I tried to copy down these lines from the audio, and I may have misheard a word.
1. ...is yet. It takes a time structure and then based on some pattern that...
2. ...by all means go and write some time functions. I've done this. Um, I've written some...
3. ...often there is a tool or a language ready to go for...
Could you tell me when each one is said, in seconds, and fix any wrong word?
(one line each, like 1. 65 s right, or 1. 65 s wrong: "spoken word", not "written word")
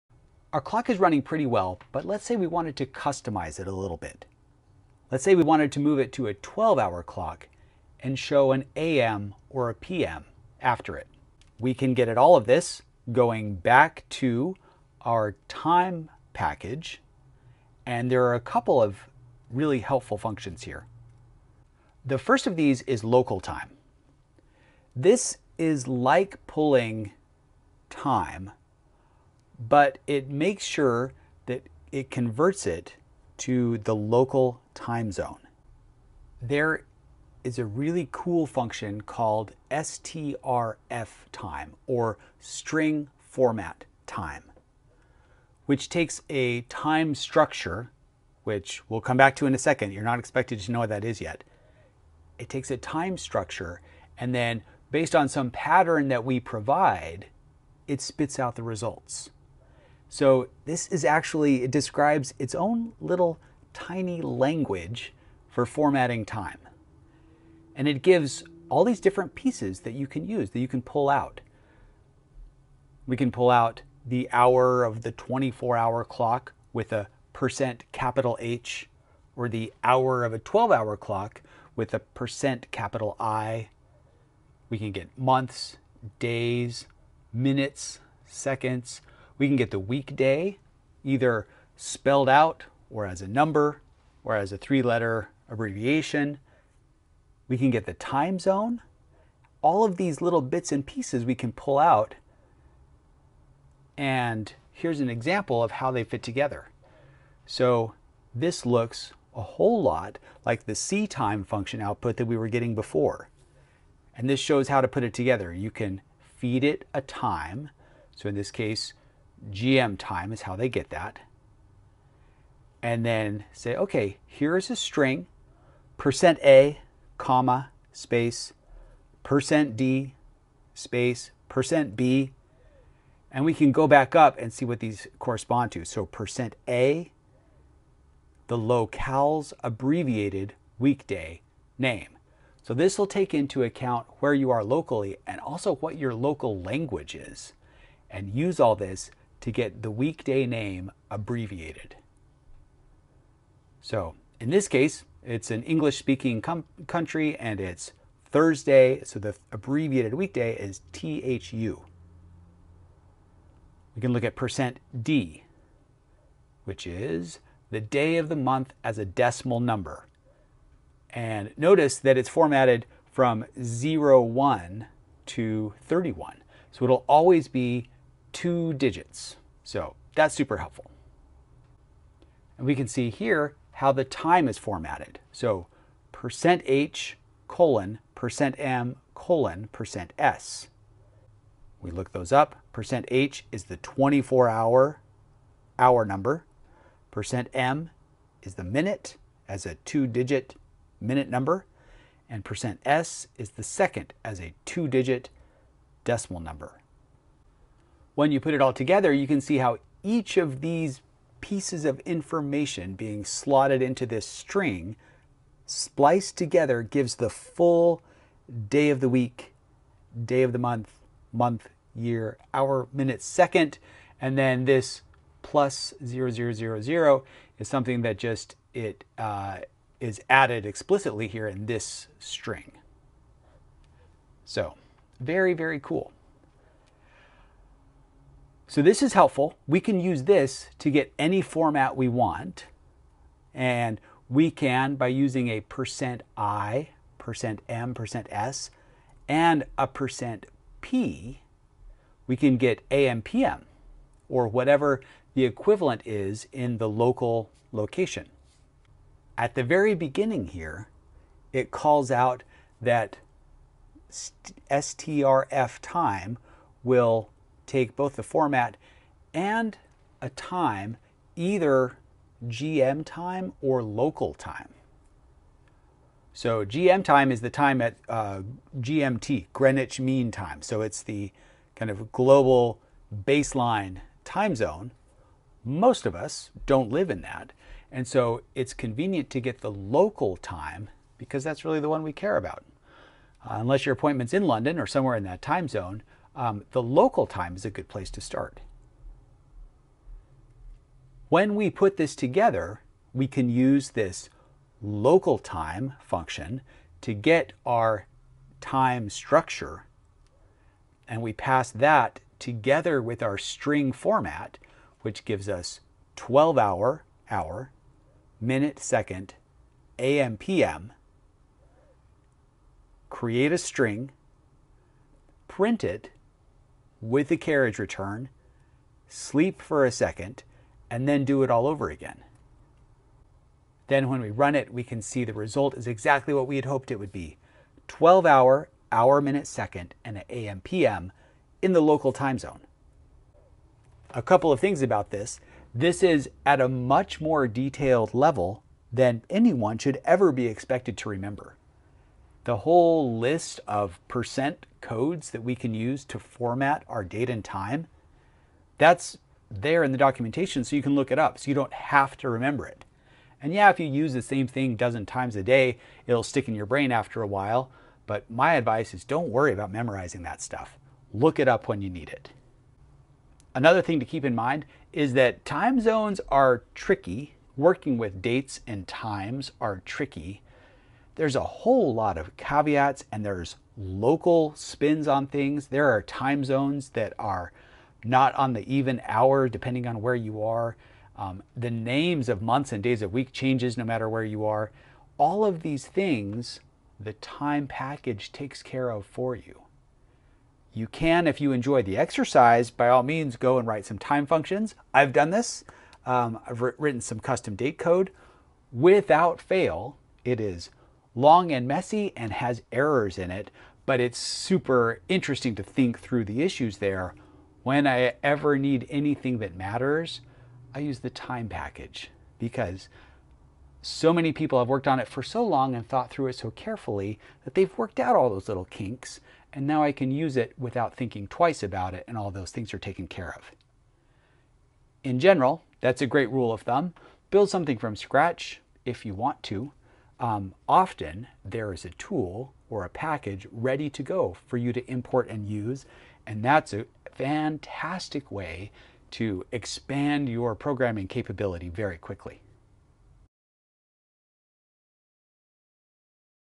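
1. 51 s right
2. 402 s right
3. 440 s wrong: "package", not "language".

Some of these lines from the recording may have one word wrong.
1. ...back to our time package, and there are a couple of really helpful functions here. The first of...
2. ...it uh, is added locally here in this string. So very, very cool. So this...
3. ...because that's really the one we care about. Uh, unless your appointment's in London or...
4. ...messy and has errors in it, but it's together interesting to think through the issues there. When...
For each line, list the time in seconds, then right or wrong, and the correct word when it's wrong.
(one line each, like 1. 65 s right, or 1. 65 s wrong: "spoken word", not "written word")
1. 13 s right
2. 228 s wrong: "explicitly", not "locally"
3. 291 s right
4. 411 s wrong: "super", not "together".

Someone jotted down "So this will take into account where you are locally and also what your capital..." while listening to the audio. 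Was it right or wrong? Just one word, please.
wrong.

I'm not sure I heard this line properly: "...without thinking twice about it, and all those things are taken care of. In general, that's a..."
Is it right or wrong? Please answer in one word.
right.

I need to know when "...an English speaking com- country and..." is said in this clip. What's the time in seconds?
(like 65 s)
155 s.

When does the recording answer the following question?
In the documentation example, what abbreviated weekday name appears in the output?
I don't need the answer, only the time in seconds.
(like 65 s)
160 s.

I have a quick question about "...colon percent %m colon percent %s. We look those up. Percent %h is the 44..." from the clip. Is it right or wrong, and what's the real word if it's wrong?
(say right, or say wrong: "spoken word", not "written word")
wrong: "24", not "44".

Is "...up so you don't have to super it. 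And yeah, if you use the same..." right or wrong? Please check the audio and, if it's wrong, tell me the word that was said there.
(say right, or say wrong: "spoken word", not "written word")
wrong: "remember", not "super".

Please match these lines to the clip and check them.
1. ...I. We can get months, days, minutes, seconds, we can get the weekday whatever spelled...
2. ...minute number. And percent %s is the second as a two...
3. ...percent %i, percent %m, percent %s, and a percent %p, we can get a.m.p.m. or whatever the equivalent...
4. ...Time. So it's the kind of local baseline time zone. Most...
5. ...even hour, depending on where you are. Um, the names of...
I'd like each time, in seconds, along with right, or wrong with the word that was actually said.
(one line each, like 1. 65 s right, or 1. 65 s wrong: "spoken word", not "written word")
1. 83 s wrong: "either", not "whatever"
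2. 200 s right
3. 245 s right
4. 280 s wrong: "global", not "local"
5. 388 s right.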